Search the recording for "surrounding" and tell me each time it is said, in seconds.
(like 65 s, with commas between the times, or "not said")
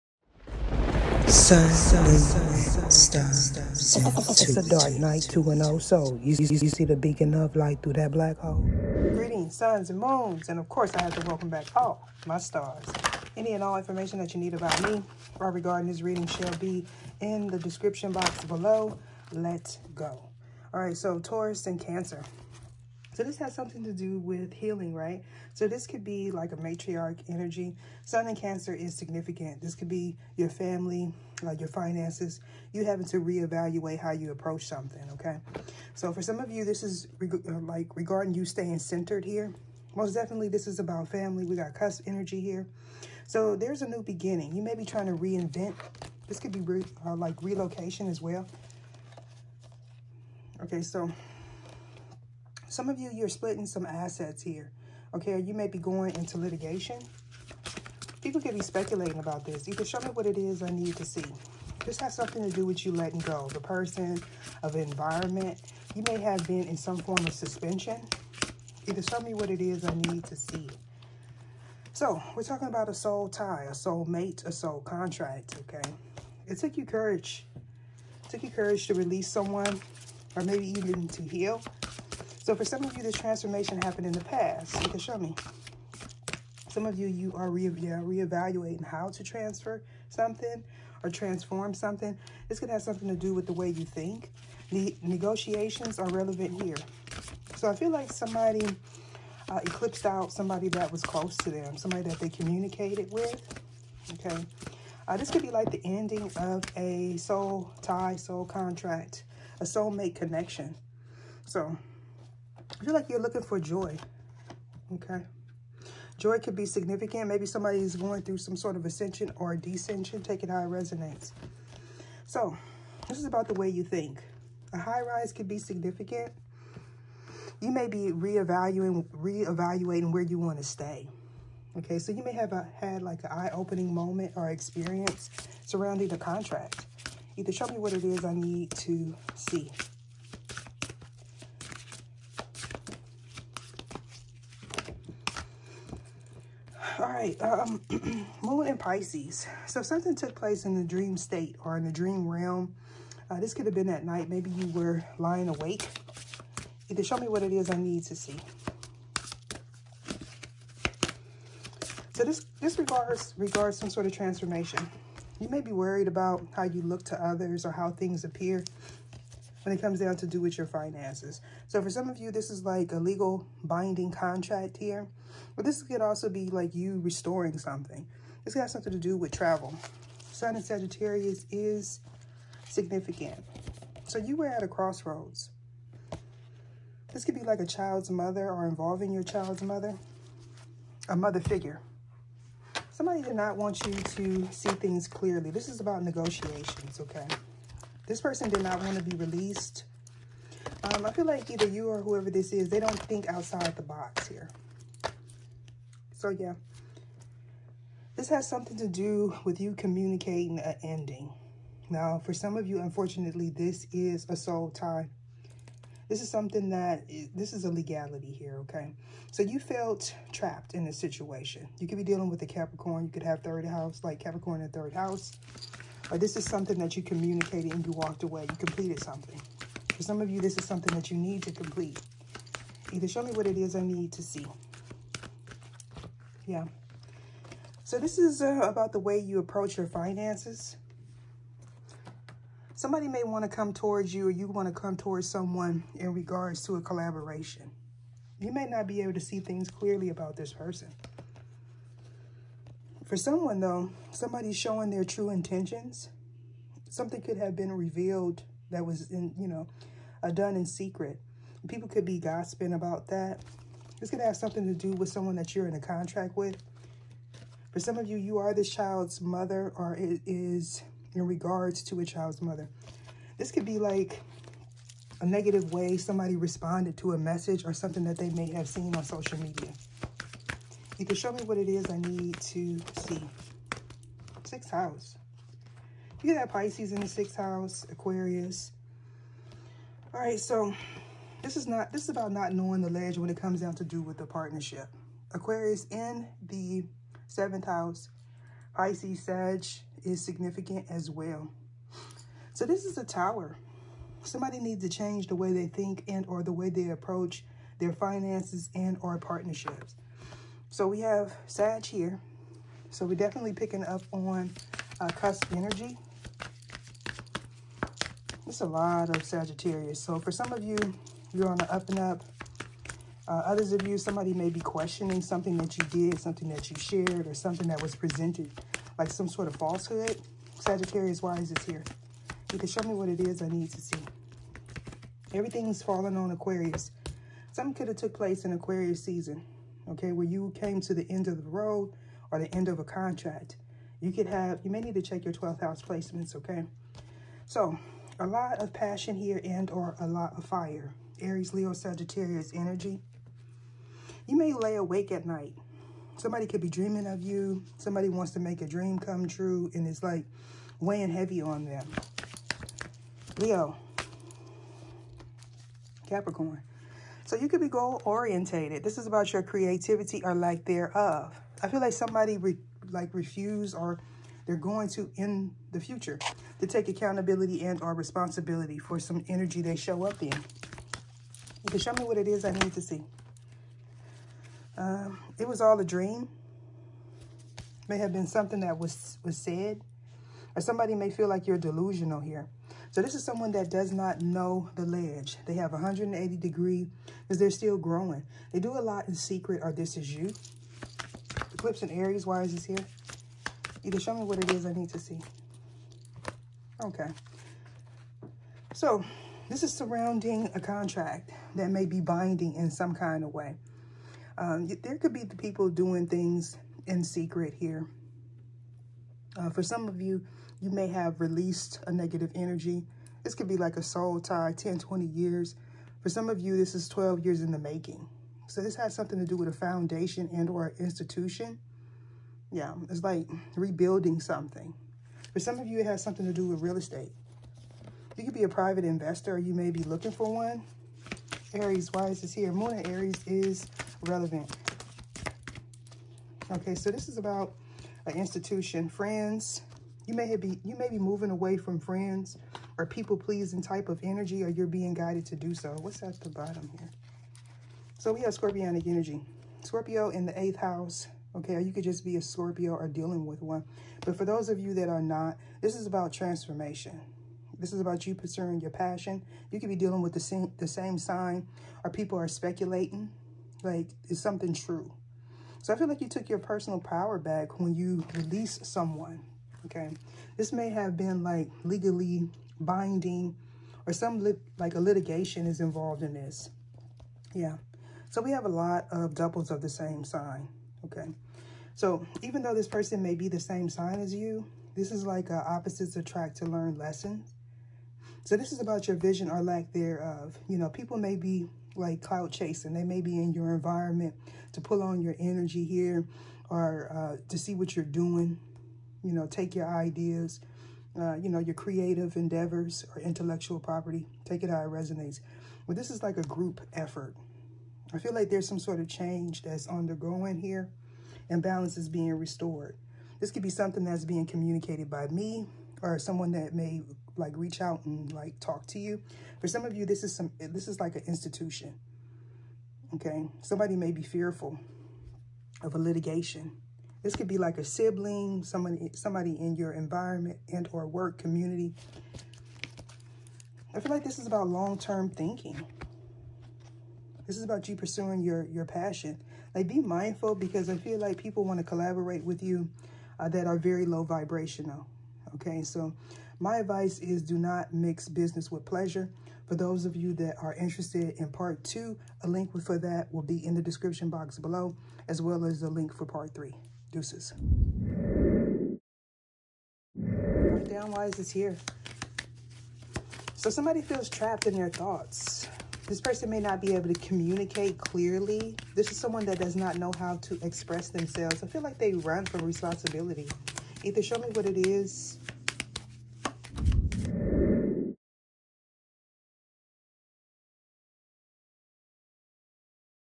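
135 s, 409 s.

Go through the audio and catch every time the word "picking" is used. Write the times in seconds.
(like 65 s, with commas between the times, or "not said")
313 s.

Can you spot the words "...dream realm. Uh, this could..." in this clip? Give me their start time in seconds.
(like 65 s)
151 s.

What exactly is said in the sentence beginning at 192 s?
Somebody did not want you to see things clearly.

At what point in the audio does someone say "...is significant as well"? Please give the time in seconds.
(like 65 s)
300 s.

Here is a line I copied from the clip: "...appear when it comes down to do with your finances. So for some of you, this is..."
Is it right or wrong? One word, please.
right.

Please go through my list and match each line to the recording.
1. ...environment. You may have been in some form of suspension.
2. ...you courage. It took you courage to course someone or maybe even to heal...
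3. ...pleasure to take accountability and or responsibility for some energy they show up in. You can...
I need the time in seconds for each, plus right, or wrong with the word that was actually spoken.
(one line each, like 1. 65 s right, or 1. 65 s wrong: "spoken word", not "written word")
1. 64 s right
2. 76 s wrong: "release", not "course"
3. 375 s wrong: "future", not "pleasure".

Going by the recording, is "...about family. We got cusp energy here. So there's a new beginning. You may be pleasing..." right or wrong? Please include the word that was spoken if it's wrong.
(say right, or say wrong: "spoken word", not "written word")
wrong: "trying", not "pleasing".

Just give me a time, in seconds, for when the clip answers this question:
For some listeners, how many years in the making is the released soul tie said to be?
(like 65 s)
426 s.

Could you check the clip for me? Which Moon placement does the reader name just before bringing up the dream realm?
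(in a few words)
Moon and Pisces.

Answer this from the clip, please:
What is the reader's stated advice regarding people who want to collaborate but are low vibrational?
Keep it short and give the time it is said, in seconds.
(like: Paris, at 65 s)
do not mix business with pleasure, at 557 s.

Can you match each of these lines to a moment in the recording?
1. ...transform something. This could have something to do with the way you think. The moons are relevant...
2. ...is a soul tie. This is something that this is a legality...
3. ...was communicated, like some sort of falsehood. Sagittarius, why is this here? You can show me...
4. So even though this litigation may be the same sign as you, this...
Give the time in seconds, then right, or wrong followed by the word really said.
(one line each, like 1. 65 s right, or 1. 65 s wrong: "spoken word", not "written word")
1. 91 s wrong: "negotiations", not "moons"
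2. 213 s right
3. 327 s wrong: "presented", not "communicated"
4. 491 s wrong: "person", not "litigation".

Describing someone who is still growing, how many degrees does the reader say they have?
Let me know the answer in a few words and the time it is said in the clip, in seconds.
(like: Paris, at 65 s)
180, at 395 s.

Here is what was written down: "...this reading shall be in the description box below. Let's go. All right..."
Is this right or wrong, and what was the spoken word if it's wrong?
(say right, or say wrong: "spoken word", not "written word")
right.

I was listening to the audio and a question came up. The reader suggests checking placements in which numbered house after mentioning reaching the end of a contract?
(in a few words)
12th house.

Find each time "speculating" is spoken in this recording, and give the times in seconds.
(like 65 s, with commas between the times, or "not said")
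58 s, 472 s.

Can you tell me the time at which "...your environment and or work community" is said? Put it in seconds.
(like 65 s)
539 s.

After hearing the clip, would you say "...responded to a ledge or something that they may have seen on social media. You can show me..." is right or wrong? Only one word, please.
wrong.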